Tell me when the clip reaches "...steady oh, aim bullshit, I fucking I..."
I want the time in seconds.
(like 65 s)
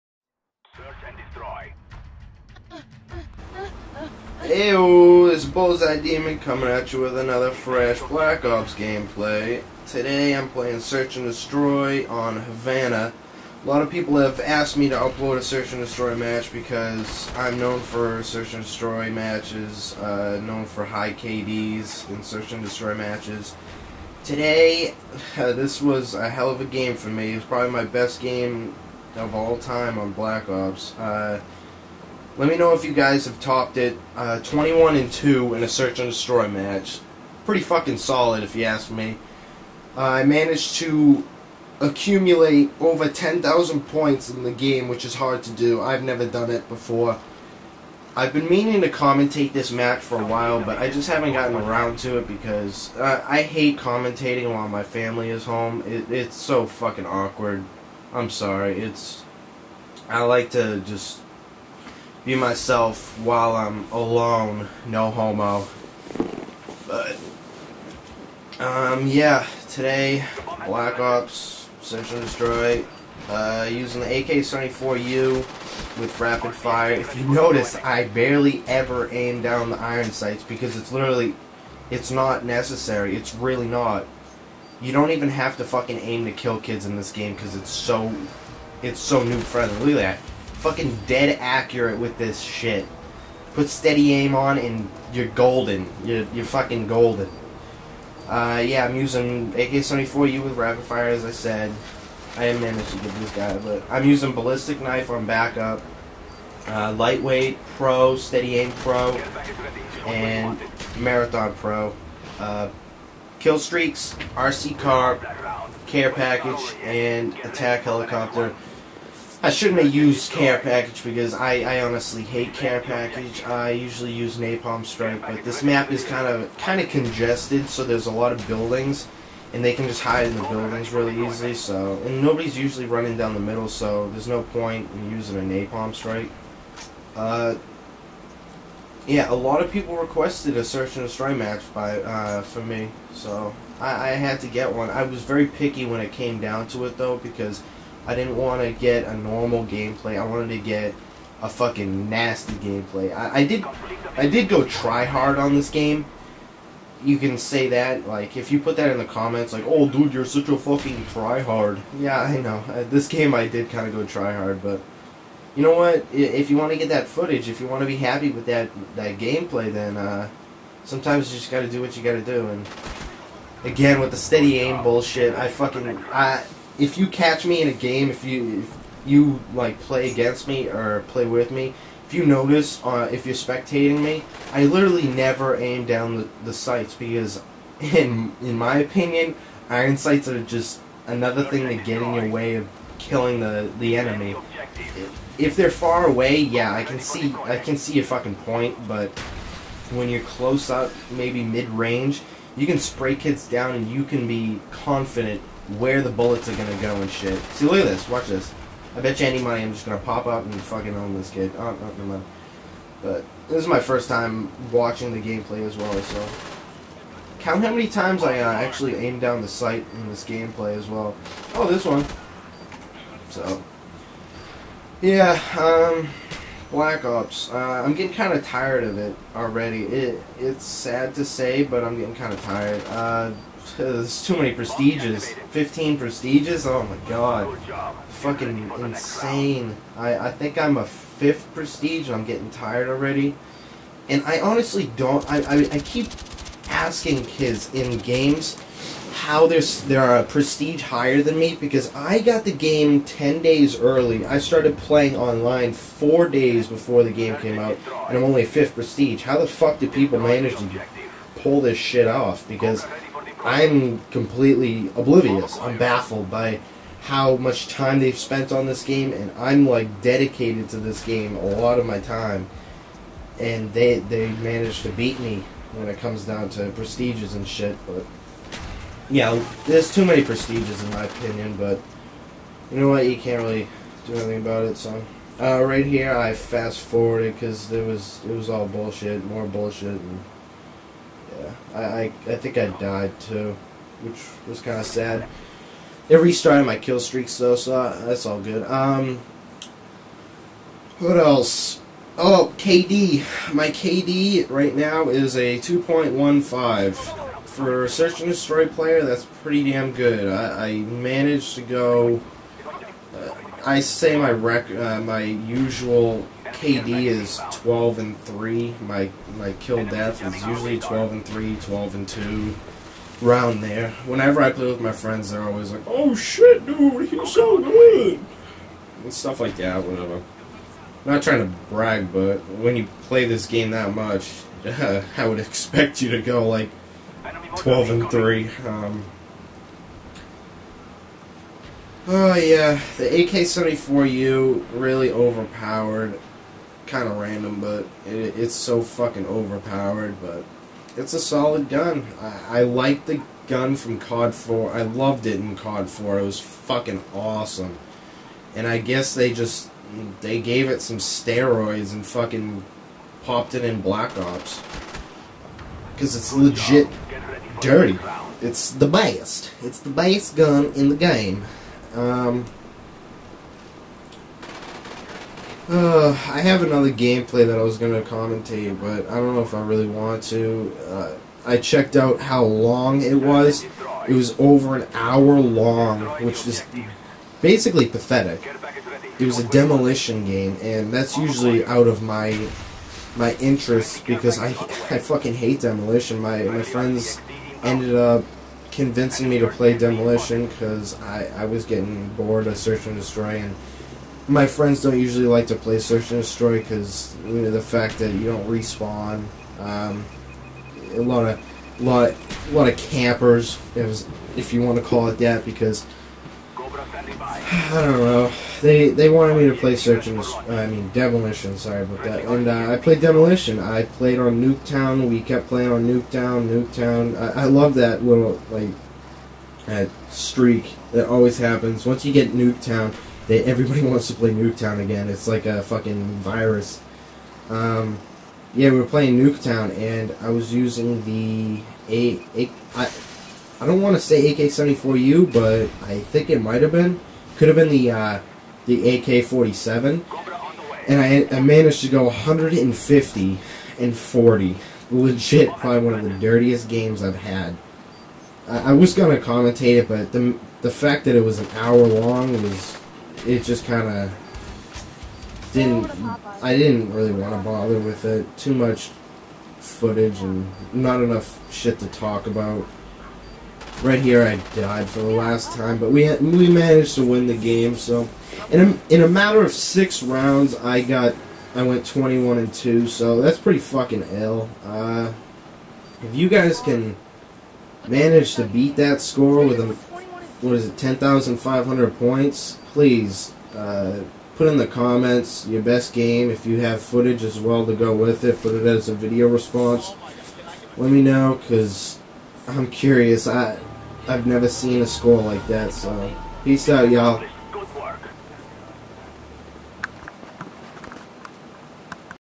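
174 s.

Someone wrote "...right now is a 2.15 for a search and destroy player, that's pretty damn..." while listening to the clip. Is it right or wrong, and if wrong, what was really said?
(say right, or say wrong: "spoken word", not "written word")
right.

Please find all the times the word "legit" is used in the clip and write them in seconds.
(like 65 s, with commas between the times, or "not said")
366 s, 454 s.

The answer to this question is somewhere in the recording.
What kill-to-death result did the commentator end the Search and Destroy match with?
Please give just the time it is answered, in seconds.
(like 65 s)
34 s.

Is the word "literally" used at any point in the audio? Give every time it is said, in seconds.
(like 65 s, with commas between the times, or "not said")
80 s, 184 s.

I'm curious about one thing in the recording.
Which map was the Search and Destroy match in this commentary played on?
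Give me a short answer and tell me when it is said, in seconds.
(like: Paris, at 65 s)
Havana, at 12 s.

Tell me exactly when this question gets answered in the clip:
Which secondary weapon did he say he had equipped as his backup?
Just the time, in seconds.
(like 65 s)
104 s.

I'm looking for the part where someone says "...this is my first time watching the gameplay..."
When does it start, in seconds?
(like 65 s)
213 s.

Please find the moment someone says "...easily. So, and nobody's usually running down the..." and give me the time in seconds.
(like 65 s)
131 s.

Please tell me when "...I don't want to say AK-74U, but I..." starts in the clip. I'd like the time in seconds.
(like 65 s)
443 s.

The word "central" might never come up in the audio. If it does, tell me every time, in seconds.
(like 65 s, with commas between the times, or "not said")
not said.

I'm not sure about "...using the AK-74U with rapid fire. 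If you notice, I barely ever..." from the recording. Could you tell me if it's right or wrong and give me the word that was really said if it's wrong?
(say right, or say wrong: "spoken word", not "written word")
right.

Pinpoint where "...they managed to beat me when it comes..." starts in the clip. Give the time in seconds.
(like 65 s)
273 s.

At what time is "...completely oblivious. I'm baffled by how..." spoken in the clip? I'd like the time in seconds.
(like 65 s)
264 s.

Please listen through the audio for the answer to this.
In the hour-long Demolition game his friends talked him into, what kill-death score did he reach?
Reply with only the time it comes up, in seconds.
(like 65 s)
452 s.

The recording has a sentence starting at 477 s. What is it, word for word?
So, in a, in a matter of six rounds, I got I went 21 and two.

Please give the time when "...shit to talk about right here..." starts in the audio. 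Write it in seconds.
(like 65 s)
471 s.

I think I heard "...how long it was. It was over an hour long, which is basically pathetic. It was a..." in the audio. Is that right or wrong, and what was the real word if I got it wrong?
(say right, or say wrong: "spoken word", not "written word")
right.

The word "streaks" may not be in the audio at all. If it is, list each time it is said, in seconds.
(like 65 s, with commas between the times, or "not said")
113 s, 297 s, 430 s.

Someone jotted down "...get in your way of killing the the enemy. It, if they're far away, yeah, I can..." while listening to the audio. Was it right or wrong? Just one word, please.
right.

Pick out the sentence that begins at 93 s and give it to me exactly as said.
Put steady aim on and you're golden.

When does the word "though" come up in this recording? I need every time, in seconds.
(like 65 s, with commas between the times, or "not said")
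146 s, 297 s.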